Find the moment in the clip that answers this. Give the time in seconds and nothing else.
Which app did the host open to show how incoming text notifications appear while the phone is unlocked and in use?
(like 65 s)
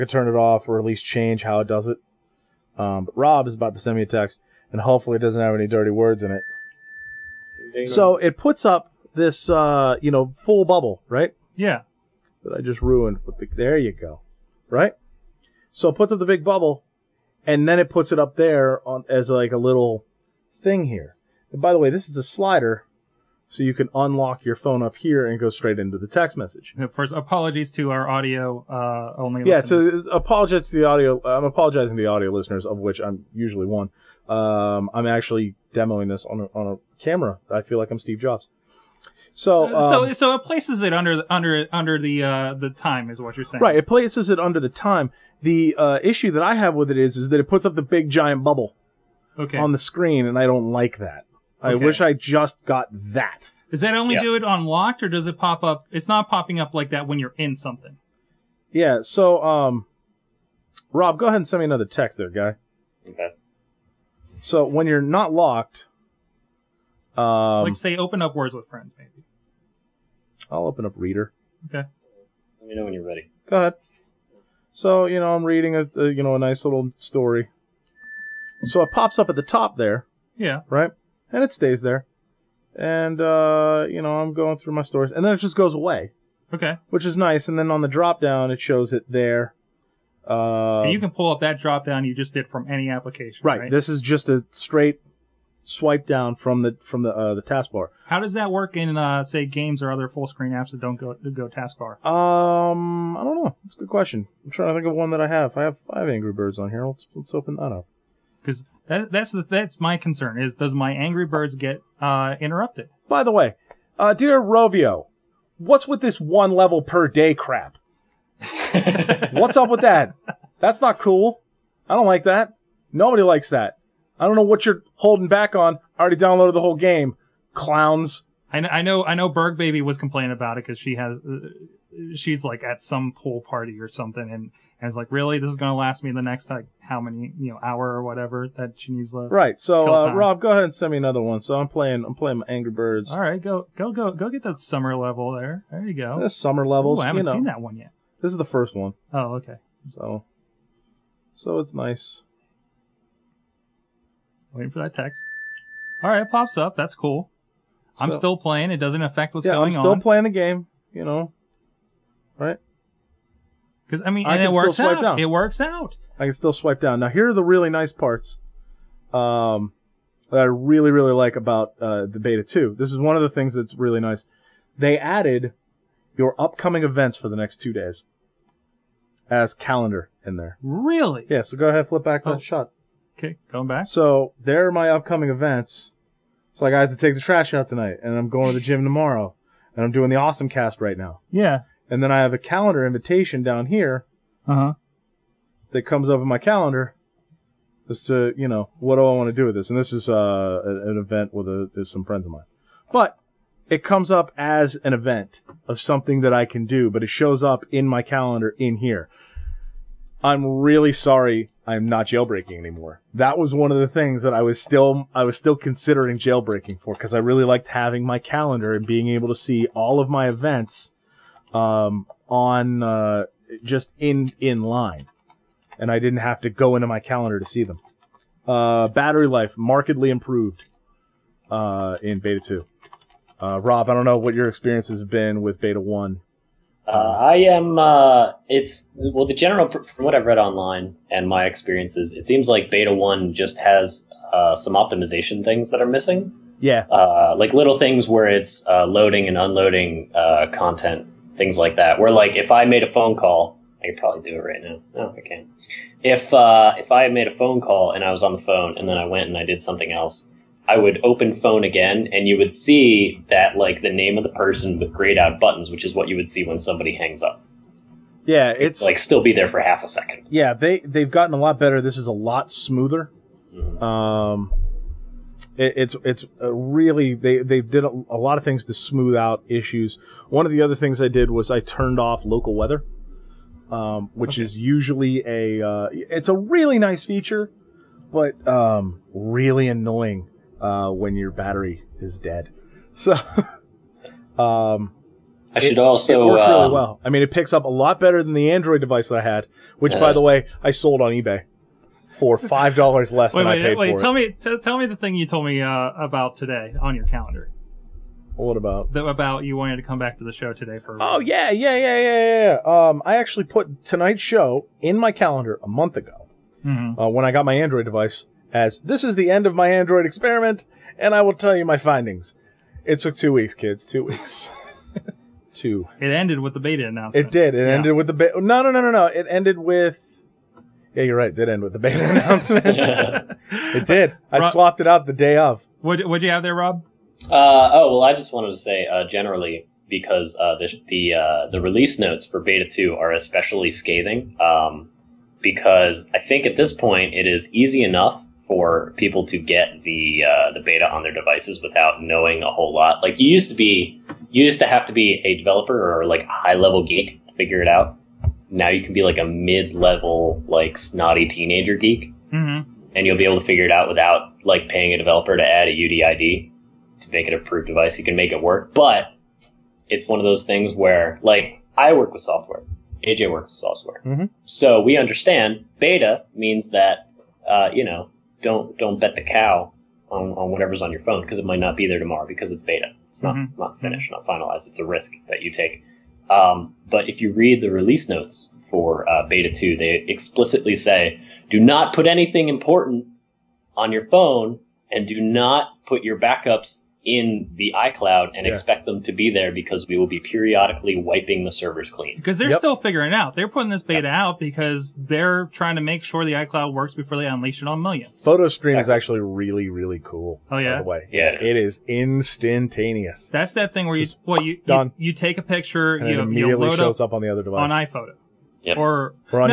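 70 s.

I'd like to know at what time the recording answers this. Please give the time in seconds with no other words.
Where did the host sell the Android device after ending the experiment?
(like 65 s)
301 s.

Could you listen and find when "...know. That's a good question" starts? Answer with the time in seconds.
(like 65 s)
103 s.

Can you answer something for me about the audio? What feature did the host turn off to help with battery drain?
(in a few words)
local weather.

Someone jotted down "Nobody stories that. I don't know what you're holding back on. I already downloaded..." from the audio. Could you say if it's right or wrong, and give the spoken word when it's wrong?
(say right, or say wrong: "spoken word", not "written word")
wrong: "likes", not "stories".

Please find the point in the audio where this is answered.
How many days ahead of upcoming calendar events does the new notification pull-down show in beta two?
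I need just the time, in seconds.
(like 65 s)
177 s.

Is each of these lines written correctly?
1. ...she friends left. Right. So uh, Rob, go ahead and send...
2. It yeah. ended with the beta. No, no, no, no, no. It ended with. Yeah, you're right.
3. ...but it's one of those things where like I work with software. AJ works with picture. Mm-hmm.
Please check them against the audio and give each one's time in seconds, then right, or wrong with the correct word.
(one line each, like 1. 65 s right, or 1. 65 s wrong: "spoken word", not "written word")
1. 138 s wrong: "needs", not "friends"
2. 327 s right
3. 368 s wrong: "software", not "picture".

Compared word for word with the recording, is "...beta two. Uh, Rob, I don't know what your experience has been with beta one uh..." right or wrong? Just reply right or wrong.
right.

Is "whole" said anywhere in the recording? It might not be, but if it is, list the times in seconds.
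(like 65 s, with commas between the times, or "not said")
126 s, 352 s.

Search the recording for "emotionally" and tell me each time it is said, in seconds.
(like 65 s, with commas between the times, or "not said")
not said.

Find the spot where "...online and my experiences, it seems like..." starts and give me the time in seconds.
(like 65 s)
240 s.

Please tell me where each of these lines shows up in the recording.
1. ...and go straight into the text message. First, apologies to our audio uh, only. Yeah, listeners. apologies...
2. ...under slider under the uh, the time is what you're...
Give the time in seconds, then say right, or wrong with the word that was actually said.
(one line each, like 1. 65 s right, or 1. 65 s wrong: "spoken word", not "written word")
1. 25 s right
2. 40 s wrong: "under", not "slider".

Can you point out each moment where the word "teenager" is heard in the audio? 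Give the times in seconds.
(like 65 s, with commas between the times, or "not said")
361 s.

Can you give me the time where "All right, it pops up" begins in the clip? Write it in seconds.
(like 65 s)
156 s.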